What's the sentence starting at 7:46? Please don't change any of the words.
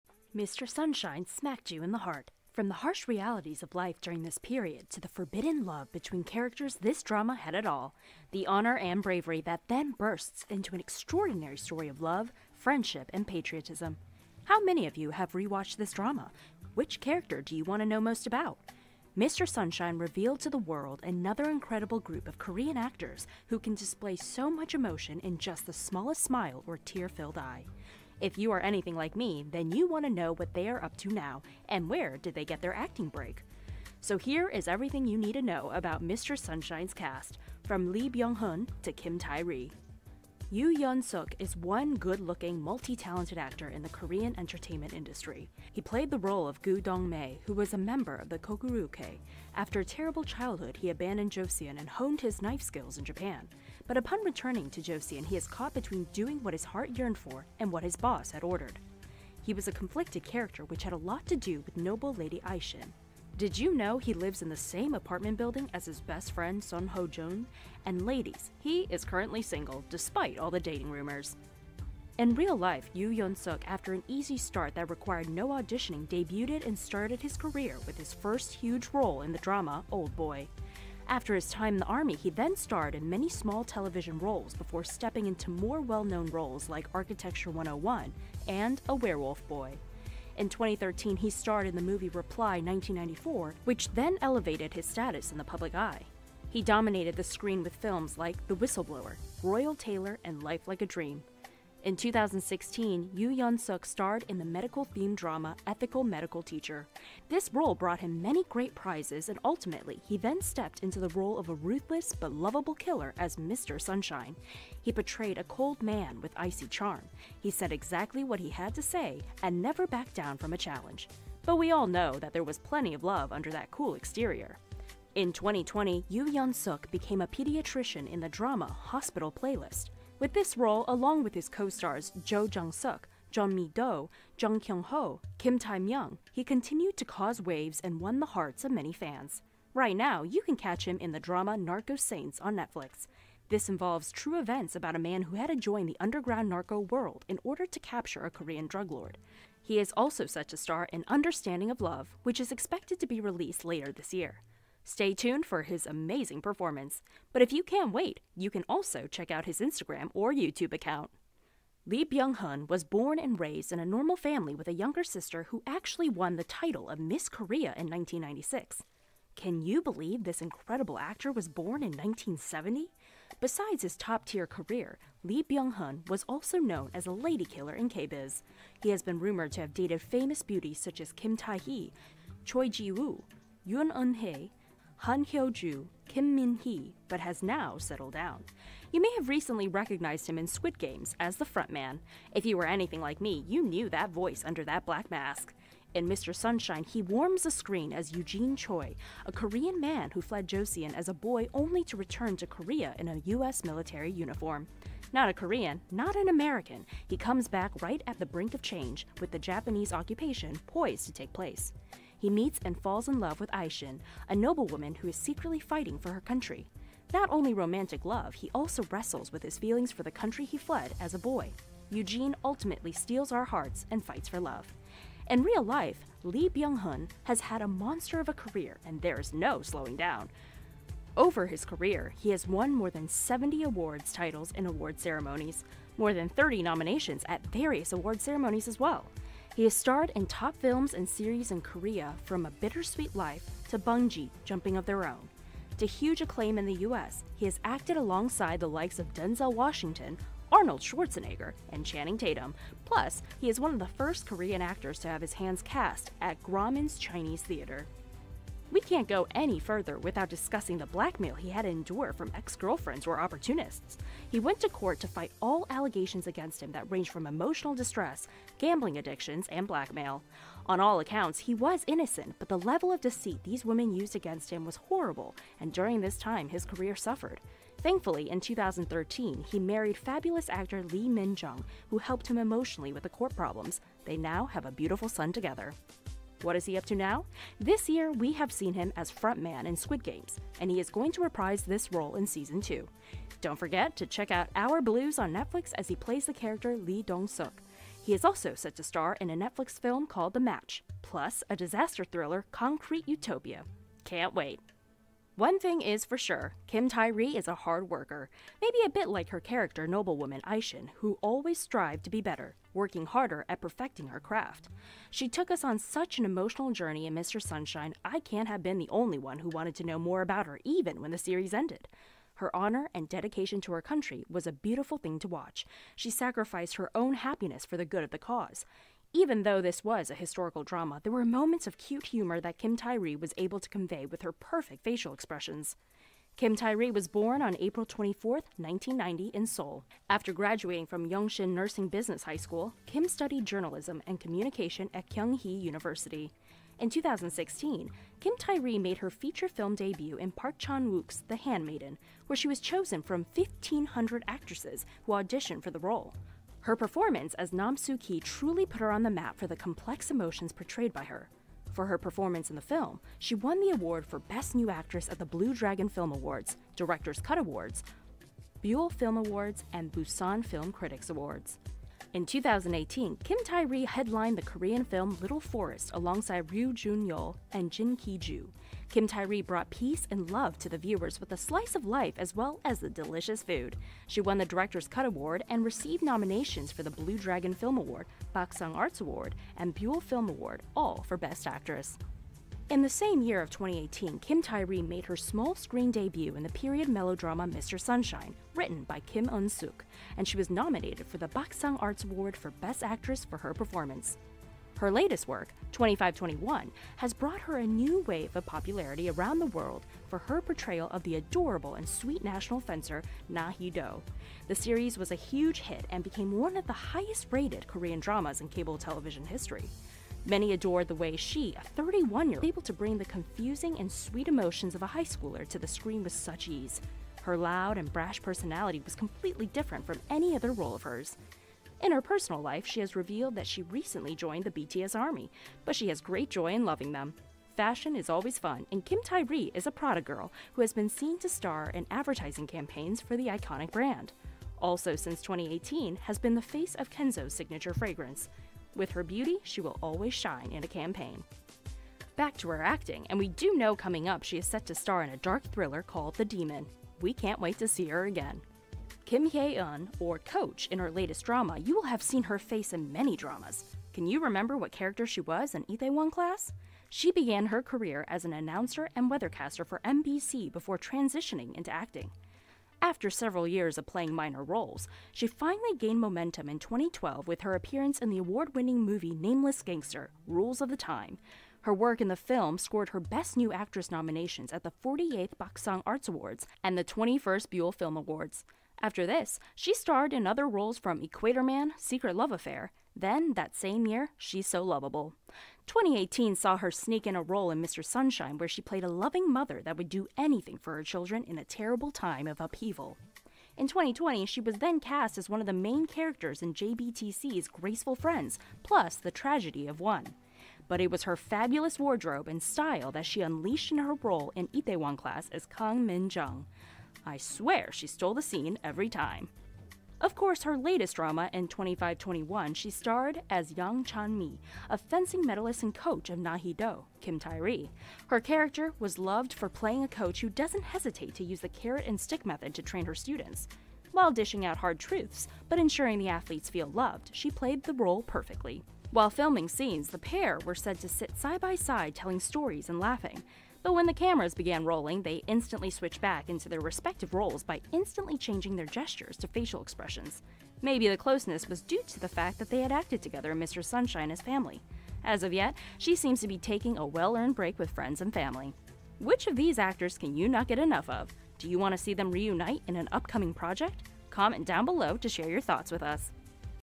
She began her career as an announcer and weathercaster for MBC before transitioning into acting.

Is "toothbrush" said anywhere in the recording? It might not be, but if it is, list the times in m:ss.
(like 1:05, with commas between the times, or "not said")
not said.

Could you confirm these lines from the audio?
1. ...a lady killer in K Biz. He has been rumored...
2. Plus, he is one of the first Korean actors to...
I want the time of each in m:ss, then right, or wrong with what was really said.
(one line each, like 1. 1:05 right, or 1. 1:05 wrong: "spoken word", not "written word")
1. 2:57 right
2. 4:12 right.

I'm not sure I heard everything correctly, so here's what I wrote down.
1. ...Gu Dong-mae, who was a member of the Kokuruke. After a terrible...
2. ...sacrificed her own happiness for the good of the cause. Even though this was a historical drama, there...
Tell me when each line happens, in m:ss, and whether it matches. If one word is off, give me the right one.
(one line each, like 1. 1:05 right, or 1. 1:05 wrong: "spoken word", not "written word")
1. 0:46 right
2. 5:26 right.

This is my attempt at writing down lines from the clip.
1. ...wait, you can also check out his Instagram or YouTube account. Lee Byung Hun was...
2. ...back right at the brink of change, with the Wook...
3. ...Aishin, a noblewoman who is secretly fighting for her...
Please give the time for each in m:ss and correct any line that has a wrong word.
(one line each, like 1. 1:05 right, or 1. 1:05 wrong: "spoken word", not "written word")
1. 2:37 right
2. 3:27 wrong: "Japanese", not "Wook"
3. 3:33 right.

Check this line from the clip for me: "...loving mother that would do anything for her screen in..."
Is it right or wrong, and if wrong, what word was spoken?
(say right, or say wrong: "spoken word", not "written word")
wrong: "children", not "screen".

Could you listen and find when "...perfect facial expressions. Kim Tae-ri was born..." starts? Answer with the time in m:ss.
5:34.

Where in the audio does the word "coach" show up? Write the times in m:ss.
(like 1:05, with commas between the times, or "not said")
7:40, 8:45, 8:49.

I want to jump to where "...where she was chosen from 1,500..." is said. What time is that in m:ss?
5:52.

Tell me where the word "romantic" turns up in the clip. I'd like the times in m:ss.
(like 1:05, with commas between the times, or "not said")
3:37.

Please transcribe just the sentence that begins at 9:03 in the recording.
Though when the cameras began rolling, they instantly switched back into their respective roles by instantly changing their gestures to facial expressions.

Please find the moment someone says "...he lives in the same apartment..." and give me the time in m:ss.
1:03.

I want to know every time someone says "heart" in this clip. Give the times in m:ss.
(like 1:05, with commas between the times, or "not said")
0:01, 0:56, 2:18, 3:43.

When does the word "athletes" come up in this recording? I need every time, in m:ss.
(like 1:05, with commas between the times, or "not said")
8:56.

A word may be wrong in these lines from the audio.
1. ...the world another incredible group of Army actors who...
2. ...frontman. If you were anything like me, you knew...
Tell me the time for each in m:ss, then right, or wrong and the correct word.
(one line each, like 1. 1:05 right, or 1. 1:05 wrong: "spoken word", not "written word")
1. 0:20 wrong: "Korean", not "Army"
2. 3:11 right.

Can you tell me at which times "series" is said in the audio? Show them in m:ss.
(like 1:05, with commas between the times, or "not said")
4:01, 5:21, 6:54.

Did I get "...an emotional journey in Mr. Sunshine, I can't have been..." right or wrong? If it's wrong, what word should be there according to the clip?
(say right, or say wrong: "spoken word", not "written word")
right.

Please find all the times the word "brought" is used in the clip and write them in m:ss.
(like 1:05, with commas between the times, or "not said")
1:47, 6:19, 6:47.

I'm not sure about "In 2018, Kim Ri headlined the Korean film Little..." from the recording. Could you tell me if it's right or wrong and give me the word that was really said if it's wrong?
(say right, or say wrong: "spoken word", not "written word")
right.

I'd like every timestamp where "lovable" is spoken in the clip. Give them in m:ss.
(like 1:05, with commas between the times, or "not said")
1:52, 8:14.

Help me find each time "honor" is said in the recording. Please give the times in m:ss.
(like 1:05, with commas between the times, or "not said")
0:08, 5:22.